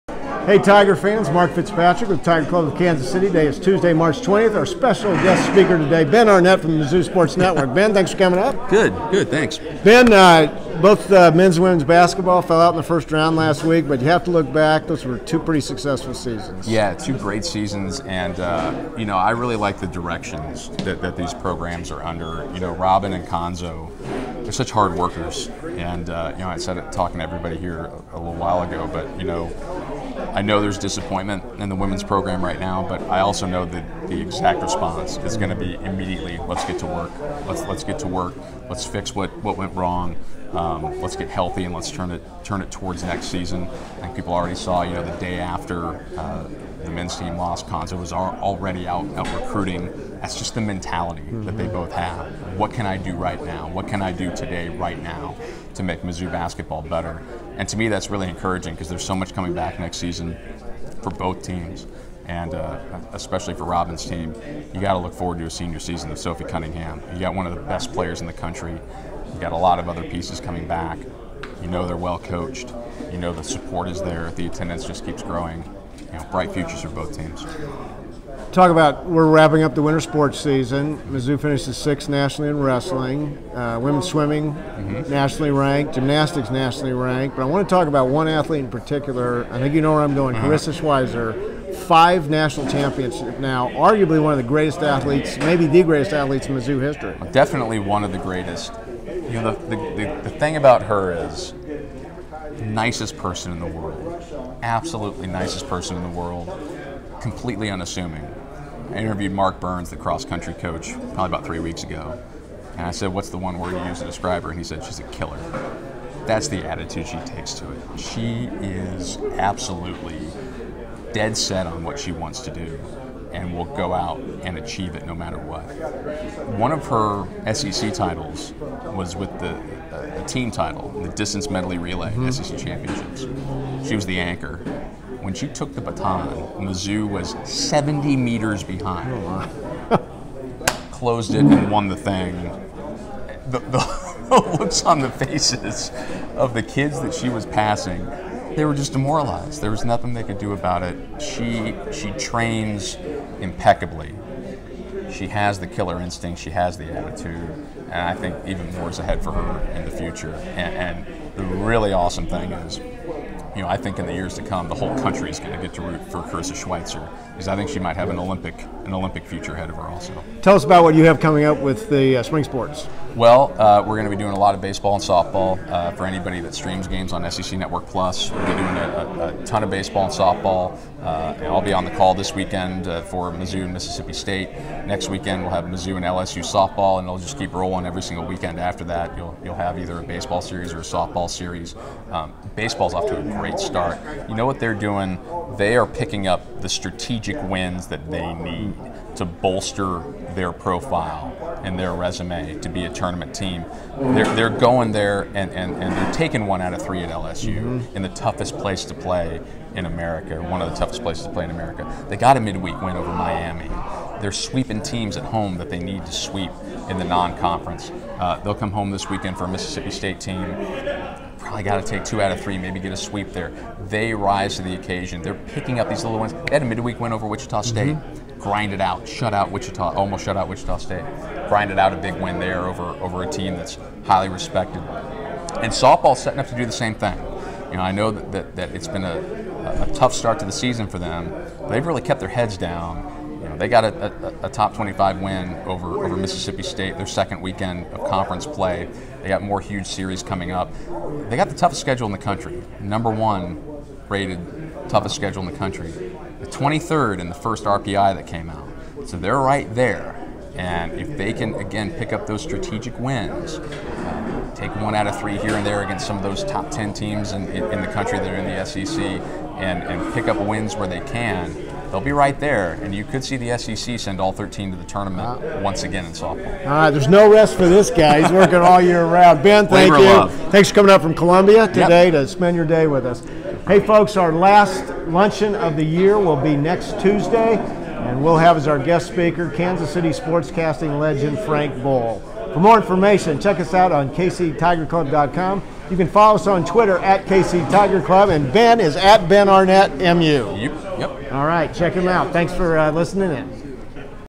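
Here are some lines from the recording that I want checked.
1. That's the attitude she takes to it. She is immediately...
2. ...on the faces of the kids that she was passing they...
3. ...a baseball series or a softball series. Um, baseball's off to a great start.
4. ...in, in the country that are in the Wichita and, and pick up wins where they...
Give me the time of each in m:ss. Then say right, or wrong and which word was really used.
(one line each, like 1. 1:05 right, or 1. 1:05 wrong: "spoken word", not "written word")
1. 1:56 wrong: "absolutely", not "immediately"
2. 2:24 right
3. 3:09 right
4. 4:27 wrong: "SEC", not "Wichita".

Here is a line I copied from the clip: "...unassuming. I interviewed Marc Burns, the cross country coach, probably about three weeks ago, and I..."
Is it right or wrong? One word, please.
right.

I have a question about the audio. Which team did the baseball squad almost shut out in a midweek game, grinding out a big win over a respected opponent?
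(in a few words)
Wichita State.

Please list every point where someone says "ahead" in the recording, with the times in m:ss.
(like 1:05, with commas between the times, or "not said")
2:38, 2:49.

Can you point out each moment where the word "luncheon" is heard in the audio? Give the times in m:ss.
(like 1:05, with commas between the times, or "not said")
4:45.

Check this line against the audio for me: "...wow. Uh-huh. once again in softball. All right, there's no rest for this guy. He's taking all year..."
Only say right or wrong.
wrong.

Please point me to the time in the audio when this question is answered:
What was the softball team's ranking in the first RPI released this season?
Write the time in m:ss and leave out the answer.
4:16.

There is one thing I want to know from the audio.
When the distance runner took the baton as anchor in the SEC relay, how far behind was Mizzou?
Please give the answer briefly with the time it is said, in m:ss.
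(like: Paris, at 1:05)
70 meters, at 2:17.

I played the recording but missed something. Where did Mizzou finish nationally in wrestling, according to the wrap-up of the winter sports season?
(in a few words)
6th.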